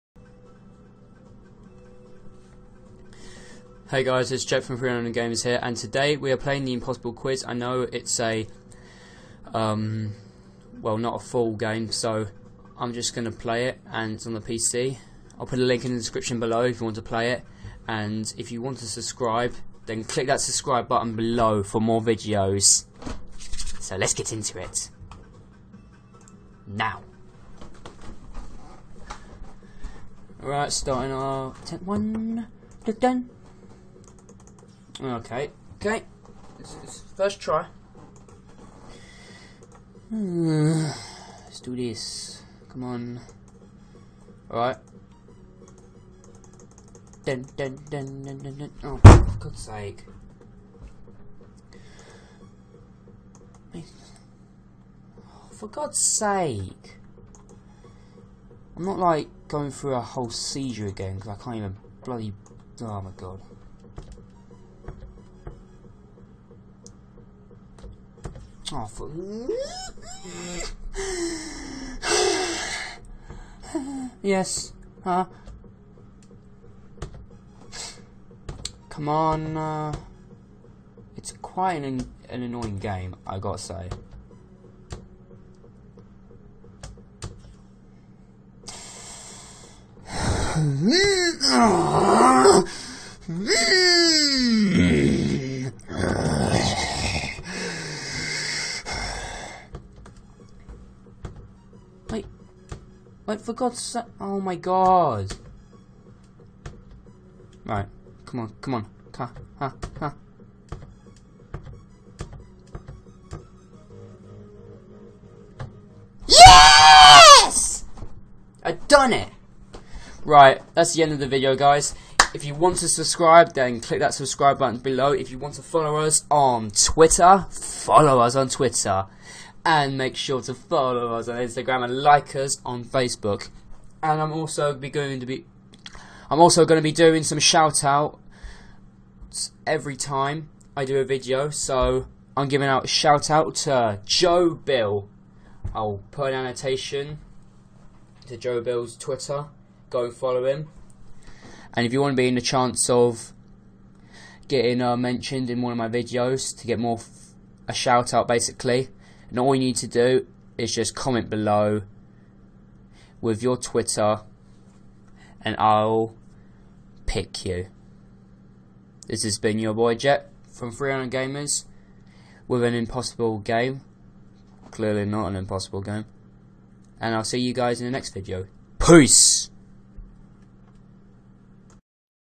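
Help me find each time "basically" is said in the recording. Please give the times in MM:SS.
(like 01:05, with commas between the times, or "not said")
02:38.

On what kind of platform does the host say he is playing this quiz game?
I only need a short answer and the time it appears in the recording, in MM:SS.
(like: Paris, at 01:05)
PC, at 00:14.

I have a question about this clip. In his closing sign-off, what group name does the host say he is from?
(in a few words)
3 Random Gamers.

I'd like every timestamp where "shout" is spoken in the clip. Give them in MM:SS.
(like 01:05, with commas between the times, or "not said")
02:17, 02:22, 02:37.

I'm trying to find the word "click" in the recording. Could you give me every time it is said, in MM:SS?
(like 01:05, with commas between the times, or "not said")
00:20, 02:03.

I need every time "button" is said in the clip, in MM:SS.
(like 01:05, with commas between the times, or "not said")
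00:20, 02:04.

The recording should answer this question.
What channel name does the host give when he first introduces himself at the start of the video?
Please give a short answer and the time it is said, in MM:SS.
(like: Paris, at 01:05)
300 Games, at 00:04.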